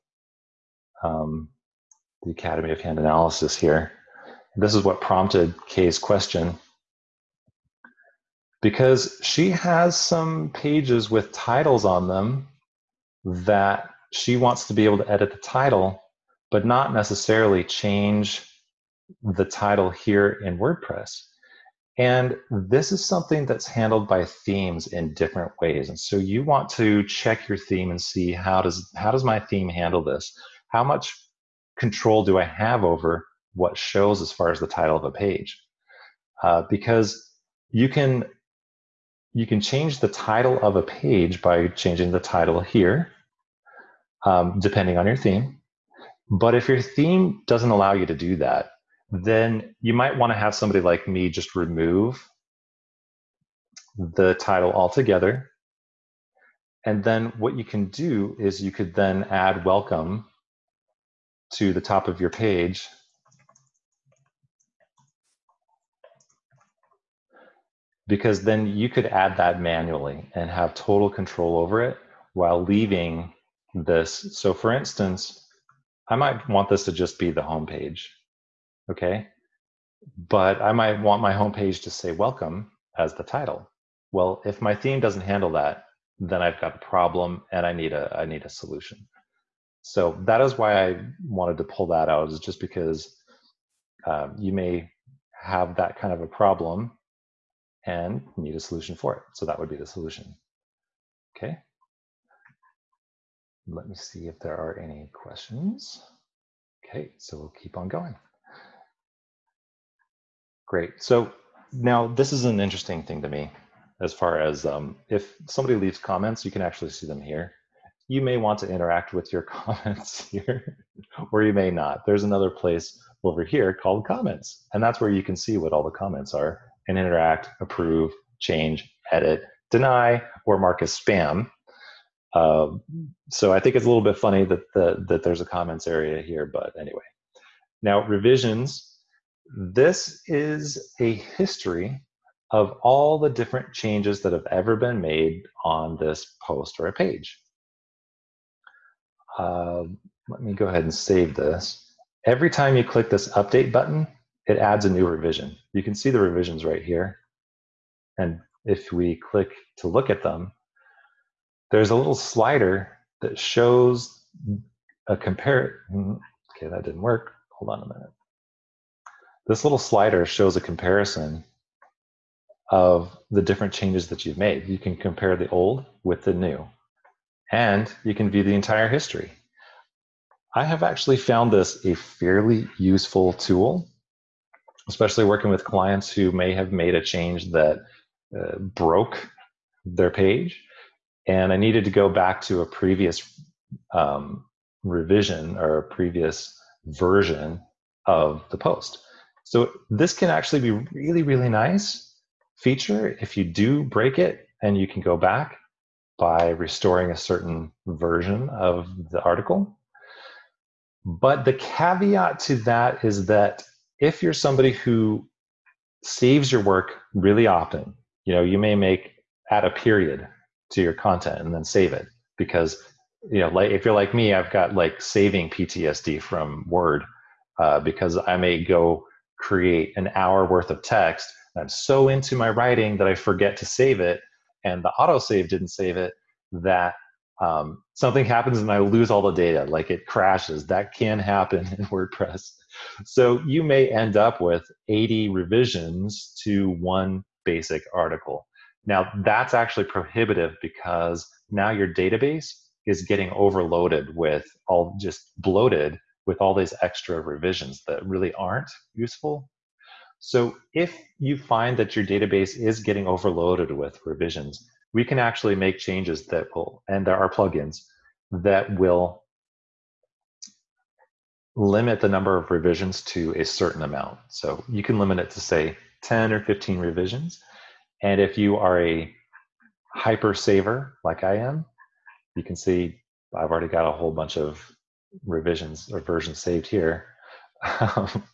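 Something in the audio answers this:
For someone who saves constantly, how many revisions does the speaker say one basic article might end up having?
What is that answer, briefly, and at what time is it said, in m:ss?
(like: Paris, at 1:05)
80, at 4:04.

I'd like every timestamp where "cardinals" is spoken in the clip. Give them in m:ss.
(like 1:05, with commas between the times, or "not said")
not said.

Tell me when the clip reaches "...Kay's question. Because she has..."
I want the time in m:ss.
0:05.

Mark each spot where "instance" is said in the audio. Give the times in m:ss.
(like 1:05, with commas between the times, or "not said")
1:14.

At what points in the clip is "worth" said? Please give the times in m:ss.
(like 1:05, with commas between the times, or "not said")
3:50.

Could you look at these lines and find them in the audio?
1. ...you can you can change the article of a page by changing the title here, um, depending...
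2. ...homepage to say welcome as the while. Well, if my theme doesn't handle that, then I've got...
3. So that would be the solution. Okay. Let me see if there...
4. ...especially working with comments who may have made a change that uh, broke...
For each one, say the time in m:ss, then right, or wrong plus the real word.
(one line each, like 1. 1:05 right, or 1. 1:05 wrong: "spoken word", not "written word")
1. 0:37 wrong: "title", not "article"
2. 1:21 wrong: "title", not "while"
3. 1:39 right
4. 3:04 wrong: "clients", not "comments".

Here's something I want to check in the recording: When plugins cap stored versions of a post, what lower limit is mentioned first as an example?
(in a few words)
10.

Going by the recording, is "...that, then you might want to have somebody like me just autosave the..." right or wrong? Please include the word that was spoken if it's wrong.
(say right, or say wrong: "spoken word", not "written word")
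wrong: "remove", not "autosave".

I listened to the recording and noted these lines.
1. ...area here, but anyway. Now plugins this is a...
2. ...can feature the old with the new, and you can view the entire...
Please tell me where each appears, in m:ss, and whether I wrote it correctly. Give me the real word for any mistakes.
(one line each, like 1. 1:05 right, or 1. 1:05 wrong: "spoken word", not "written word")
1. 2:15 wrong: "revisions", not "plugins"
2. 2:54 wrong: "compare", not "feature".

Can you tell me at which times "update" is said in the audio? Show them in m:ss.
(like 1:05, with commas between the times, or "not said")
2:33.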